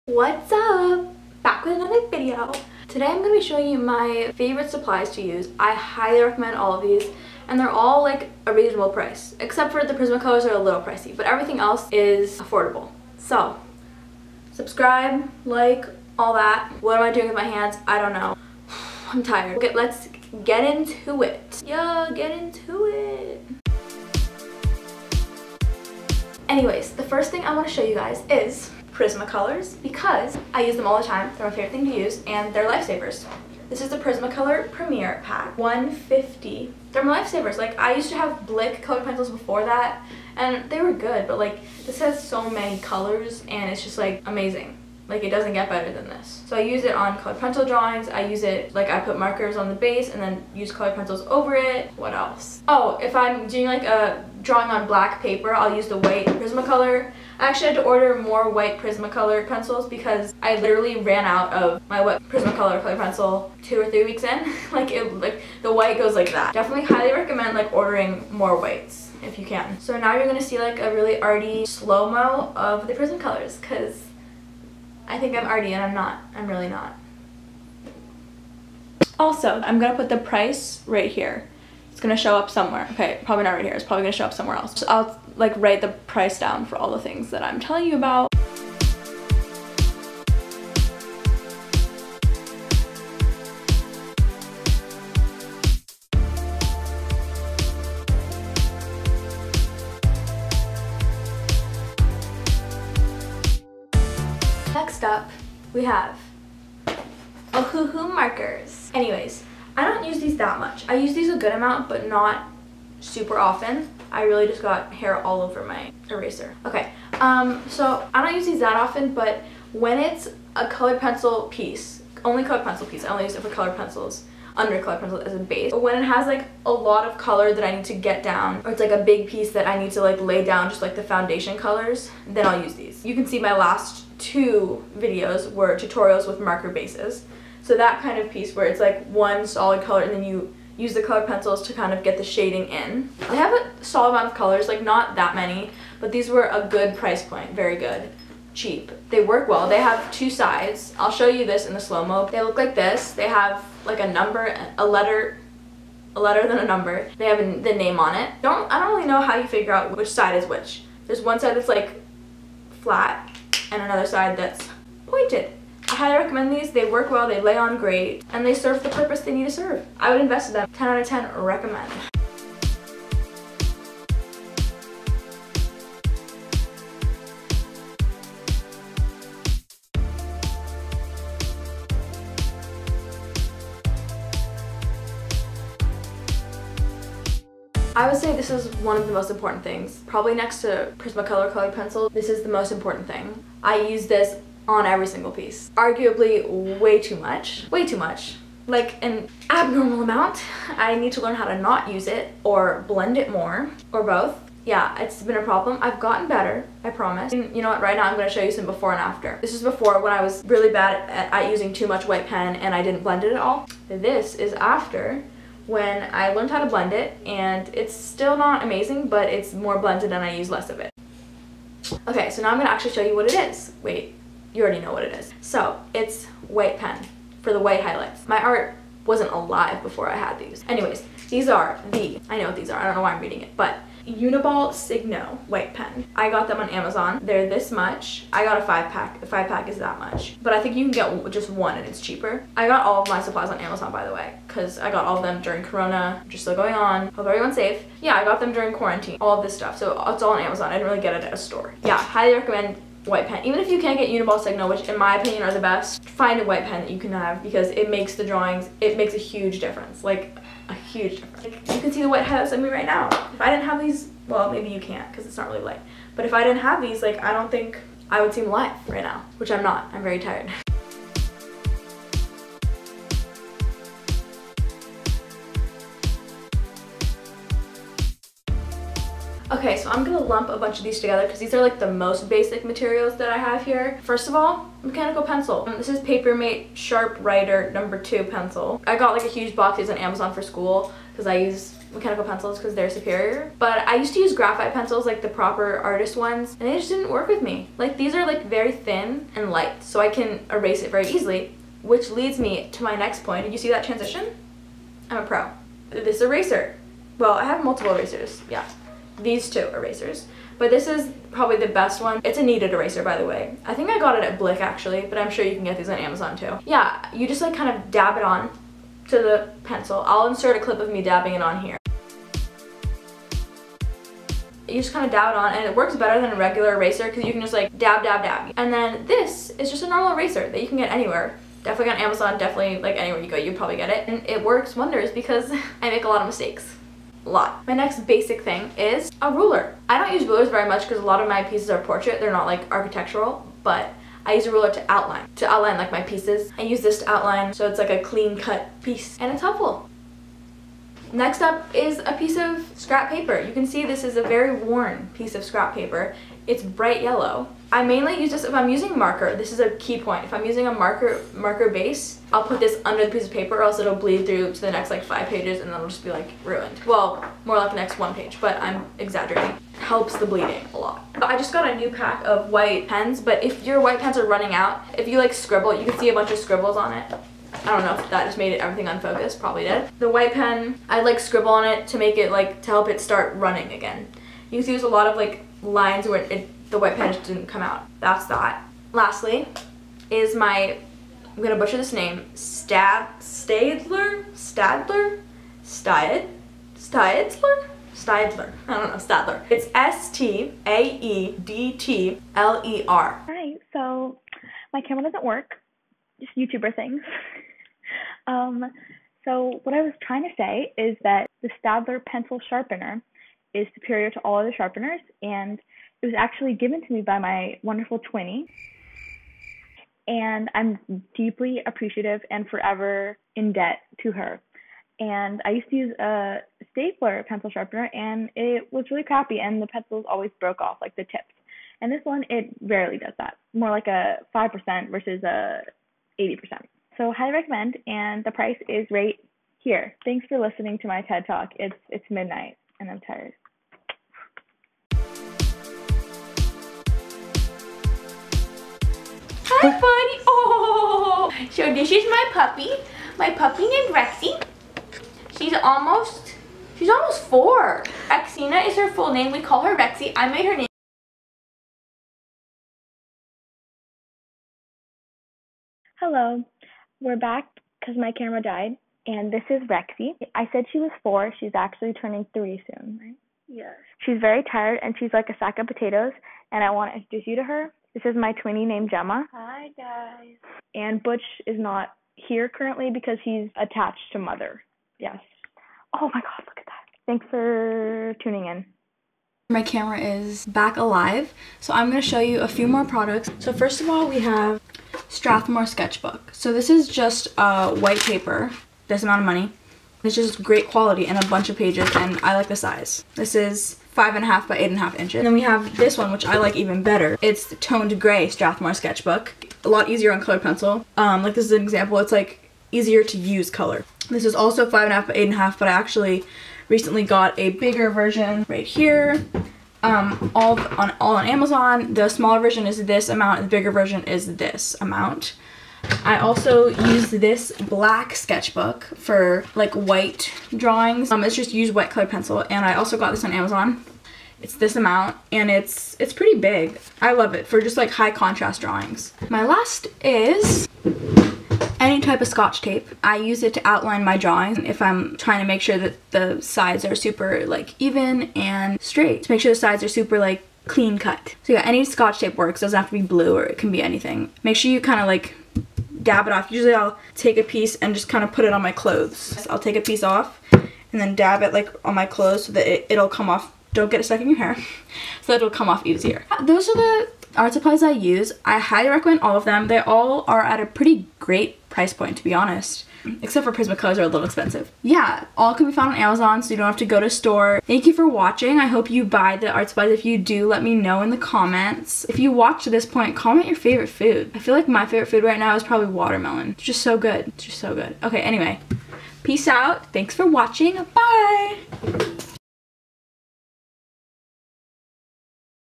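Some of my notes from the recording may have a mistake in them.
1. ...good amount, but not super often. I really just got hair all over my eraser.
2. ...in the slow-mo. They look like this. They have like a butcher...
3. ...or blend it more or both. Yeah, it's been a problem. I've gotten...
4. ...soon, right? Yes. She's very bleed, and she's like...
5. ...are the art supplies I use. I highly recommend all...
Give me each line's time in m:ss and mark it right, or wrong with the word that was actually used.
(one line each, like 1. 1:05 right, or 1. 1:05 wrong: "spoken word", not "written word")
1. 1:51 right
2. 2:31 wrong: "number", not "butcher"
3. 3:22 right
4. 7:52 wrong: "tired", not "bleed"
5. 9:26 right.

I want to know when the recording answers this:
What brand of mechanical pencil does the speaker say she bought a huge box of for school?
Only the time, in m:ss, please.
4:45.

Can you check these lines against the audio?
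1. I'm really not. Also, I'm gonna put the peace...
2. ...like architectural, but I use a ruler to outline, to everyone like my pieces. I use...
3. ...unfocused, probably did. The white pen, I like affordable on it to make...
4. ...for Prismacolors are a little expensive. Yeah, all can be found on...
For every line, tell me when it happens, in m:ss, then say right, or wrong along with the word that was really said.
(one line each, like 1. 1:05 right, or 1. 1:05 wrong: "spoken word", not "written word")
1. 1:16 wrong: "price", not "peace"
2. 5:42 wrong: "outline", not "everyone"
3. 6:18 wrong: "scribble", not "affordable"
4. 9:33 right.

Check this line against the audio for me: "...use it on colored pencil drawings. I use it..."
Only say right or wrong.
right.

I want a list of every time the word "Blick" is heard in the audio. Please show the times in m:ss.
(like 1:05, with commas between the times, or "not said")
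0:38, 5:14.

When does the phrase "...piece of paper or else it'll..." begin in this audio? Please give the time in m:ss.
6:03.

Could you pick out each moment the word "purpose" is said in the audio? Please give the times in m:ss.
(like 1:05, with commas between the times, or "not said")
2:48.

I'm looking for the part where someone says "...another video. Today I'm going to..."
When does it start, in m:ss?
0:01.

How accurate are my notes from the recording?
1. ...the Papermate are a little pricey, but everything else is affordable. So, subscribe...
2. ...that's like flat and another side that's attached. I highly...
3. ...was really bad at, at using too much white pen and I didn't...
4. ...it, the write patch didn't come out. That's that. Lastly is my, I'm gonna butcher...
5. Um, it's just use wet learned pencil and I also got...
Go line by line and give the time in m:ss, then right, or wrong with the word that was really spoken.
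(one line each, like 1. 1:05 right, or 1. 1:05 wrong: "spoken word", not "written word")
1. 0:09 wrong: "Prismacolors", not "Papermate"
2. 2:41 wrong: "pointed", not "attached"
3. 3:30 right
4. 6:26 wrong: "white", not "write"
5. 8:51 wrong: "colored", not "learned".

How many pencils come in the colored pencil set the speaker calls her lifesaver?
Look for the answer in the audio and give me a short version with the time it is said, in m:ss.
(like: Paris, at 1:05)
150, at 0:35.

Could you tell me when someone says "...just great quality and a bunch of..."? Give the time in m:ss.
8:20.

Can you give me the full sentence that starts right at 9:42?
If you watched to this point, comment your favorite food.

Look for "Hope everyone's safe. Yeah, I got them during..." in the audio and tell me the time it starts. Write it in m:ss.
4:07.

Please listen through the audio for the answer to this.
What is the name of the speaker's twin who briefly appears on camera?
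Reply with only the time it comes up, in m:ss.
7:58.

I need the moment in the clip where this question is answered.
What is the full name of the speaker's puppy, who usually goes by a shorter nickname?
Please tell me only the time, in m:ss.
7:38.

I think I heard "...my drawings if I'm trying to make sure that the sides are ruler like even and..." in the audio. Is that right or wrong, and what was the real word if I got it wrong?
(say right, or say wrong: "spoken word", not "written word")
wrong: "super", not "ruler".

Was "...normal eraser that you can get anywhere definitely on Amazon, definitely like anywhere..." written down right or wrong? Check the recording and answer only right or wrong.
right.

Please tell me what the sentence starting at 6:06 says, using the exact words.
Well, more like the next one page, but I'm exaggerating.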